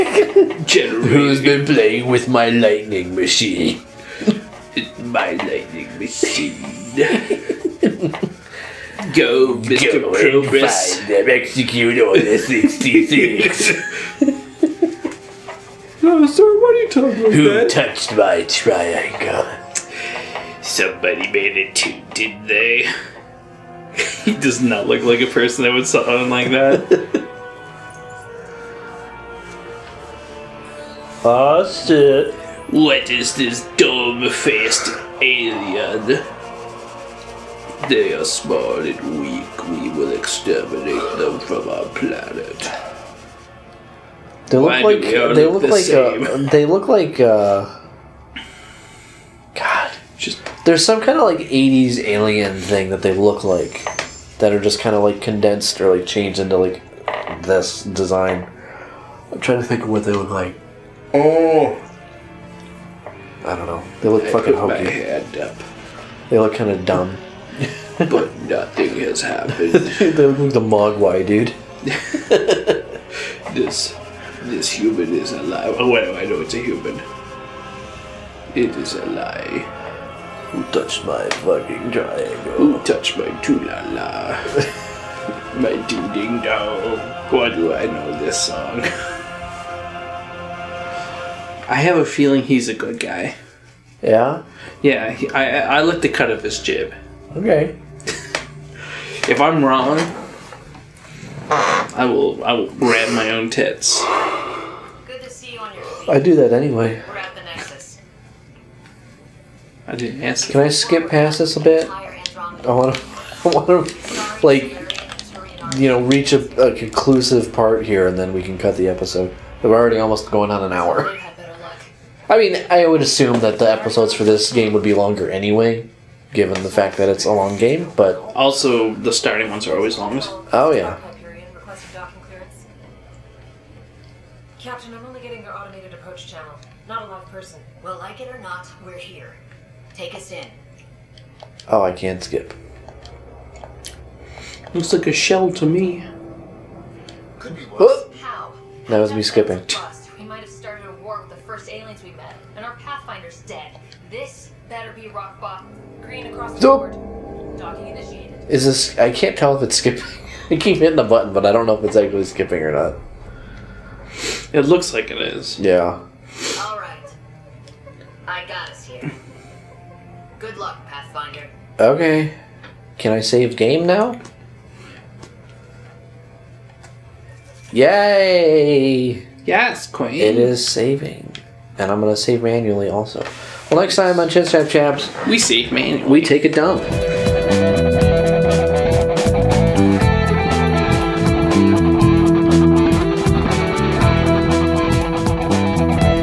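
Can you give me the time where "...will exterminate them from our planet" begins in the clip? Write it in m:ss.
0:39.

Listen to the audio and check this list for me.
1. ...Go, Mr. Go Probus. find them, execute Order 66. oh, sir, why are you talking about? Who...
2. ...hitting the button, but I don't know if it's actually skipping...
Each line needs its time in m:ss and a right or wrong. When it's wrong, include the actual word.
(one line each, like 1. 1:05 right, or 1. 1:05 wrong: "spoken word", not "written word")
1. 0:09 right
2. 2:40 right.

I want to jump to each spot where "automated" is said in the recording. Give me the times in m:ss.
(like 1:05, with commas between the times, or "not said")
2:15.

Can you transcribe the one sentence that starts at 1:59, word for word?
We're already almost going on an hour.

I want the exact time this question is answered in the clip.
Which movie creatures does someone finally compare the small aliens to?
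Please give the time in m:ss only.
1:10.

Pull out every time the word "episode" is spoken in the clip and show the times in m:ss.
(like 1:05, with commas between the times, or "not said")
1:58, 2:03.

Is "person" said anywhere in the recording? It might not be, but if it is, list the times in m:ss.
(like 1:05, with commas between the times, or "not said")
0:25, 2:17.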